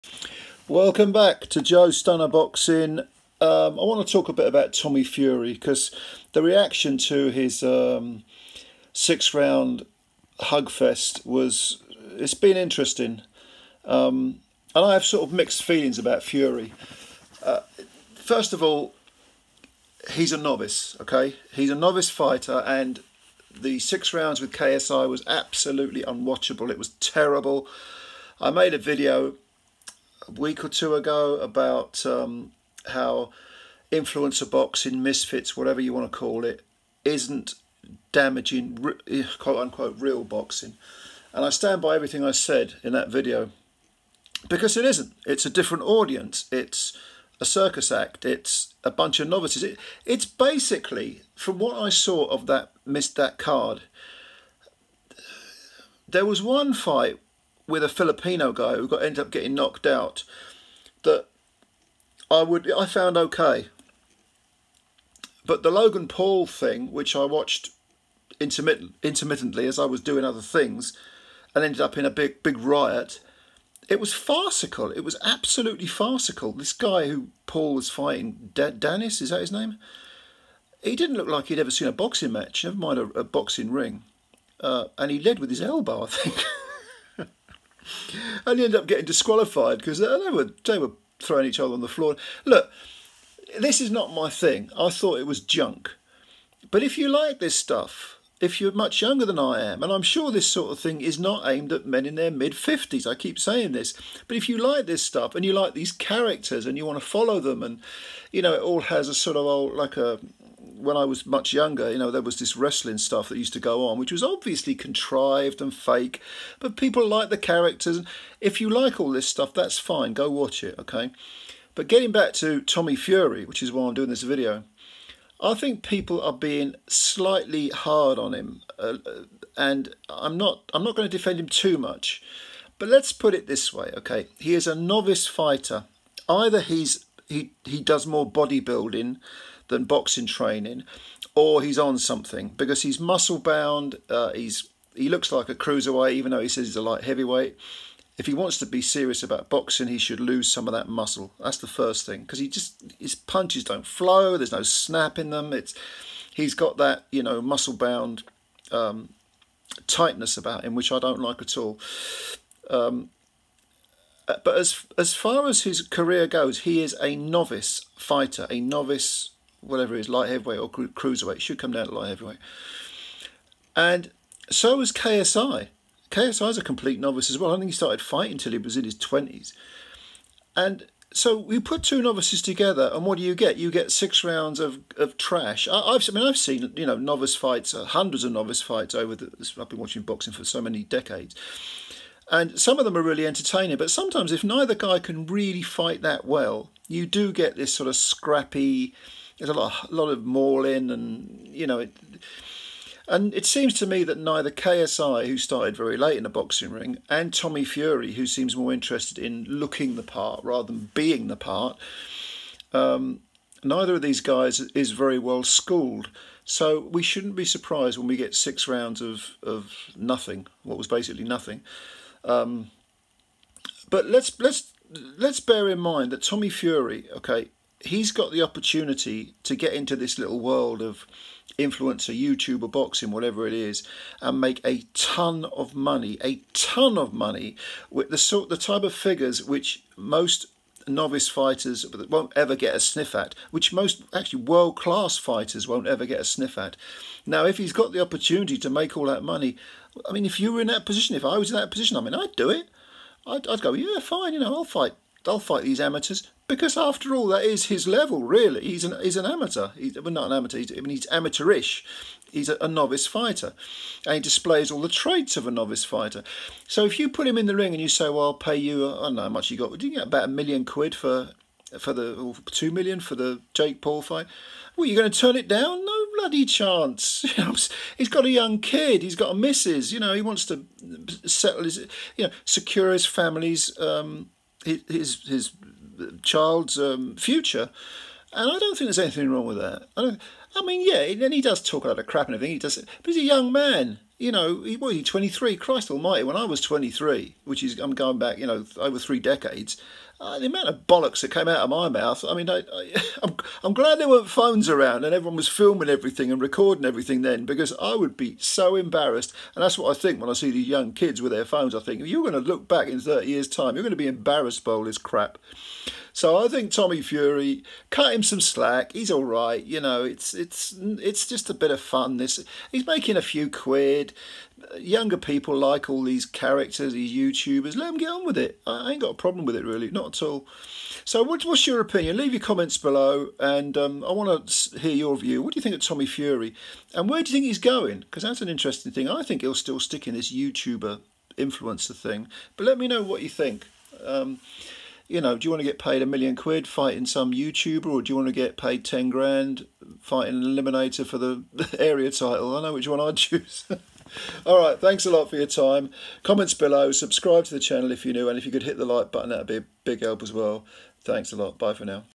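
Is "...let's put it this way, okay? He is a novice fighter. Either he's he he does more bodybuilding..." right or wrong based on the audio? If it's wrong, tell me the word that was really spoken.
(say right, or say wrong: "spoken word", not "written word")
right.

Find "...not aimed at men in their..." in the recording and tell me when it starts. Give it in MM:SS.
01:41.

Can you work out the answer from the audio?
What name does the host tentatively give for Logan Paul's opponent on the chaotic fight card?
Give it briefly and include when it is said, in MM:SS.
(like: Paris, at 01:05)
Dennis, at 01:18.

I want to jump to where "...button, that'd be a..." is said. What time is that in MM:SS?
05:59.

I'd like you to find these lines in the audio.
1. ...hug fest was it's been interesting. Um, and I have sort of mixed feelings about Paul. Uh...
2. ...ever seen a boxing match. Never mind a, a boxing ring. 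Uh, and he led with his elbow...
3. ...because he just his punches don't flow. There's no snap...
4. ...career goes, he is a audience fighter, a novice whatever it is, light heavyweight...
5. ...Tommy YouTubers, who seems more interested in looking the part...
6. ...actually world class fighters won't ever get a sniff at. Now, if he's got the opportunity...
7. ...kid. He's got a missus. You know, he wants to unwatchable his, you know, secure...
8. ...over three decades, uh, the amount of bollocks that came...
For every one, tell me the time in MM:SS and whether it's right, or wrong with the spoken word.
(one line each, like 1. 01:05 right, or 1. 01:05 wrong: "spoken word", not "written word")
1. 00:10 wrong: "Fury", not "Paul"
2. 01:21 right
3. 02:32 right
4. 02:45 wrong: "novice", not "audience"
5. 03:27 wrong: "Fury", not "YouTubers"
6. 04:04 right
7. 04:38 wrong: "settle", not "unwatchable"
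8. 04:58 right.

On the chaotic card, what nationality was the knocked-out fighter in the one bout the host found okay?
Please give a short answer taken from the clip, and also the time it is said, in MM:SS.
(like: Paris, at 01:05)
Filipino, at 00:57.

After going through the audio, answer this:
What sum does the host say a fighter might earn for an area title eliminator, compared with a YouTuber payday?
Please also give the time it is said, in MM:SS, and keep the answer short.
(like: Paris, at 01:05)
ten grand, at 05:48.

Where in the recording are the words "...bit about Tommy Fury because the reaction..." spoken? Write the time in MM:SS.
00:04.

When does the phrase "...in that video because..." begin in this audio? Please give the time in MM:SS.
00:42.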